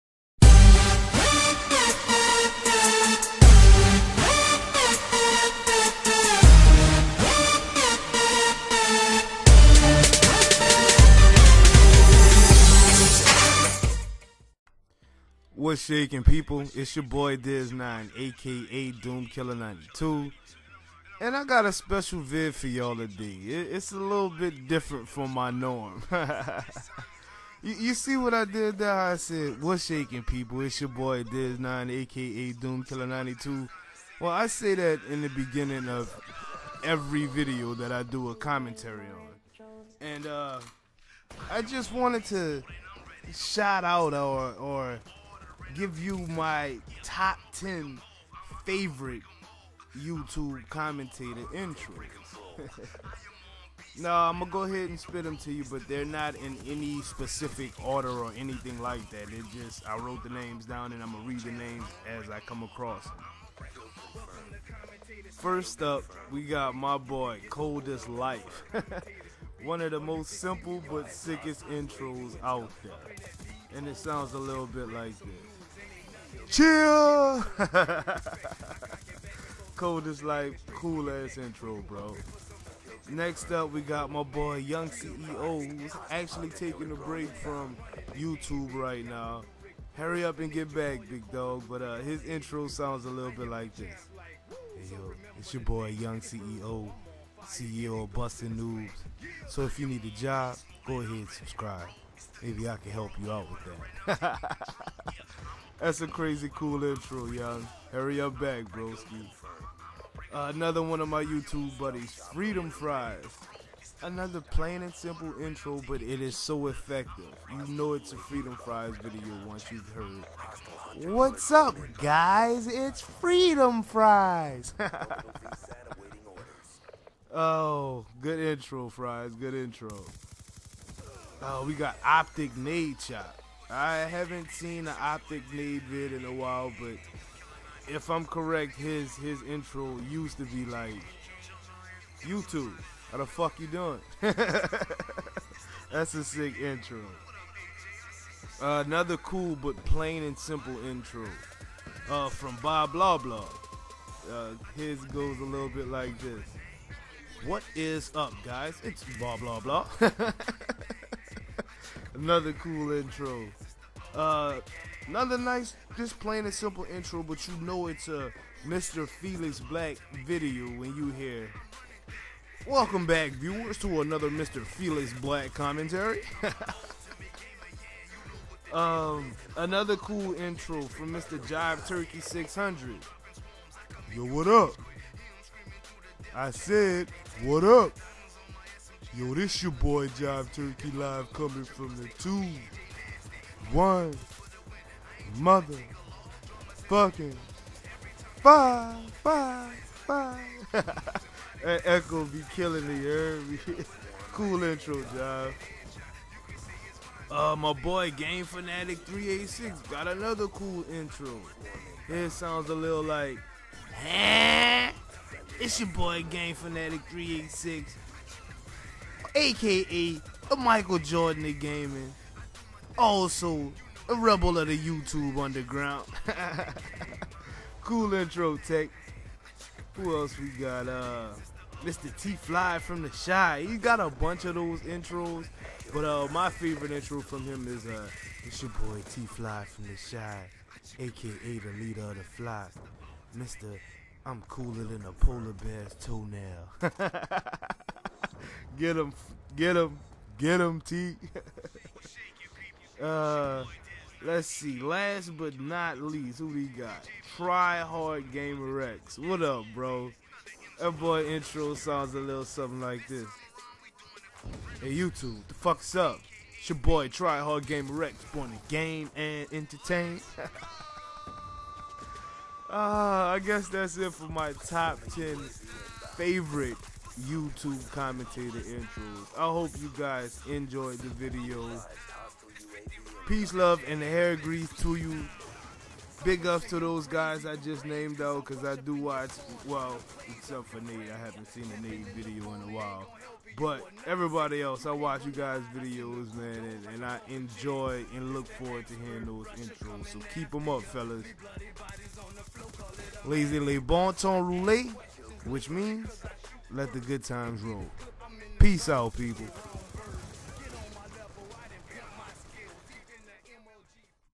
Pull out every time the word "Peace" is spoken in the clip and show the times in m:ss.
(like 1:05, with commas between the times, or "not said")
4:43, 5:08.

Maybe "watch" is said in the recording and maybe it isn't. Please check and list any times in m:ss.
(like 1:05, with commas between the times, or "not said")
4:48, 4:54.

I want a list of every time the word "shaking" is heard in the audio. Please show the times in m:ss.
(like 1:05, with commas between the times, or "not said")
0:15, 0:29.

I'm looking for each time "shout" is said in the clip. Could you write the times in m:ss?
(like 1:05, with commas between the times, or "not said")
0:43.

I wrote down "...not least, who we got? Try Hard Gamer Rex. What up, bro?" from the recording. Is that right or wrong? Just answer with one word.
right.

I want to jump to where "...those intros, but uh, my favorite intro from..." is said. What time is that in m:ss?
3:54.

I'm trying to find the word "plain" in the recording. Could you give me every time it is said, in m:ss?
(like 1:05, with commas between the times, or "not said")
1:54, 2:29, 2:46.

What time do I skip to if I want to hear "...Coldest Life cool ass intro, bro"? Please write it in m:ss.
1:19.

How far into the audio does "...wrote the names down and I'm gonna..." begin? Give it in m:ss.
0:59.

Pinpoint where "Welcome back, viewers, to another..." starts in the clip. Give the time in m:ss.
2:52.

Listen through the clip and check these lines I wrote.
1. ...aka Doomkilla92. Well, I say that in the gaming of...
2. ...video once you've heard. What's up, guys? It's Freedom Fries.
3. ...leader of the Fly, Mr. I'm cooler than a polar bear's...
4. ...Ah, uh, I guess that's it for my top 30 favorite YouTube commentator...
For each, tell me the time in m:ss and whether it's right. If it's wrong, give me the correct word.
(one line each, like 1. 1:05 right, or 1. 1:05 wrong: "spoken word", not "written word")
1. 0:31 wrong: "beginning", not "gaming"
2. 1:59 right
3. 4:01 right
4. 4:32 wrong: "10", not "30".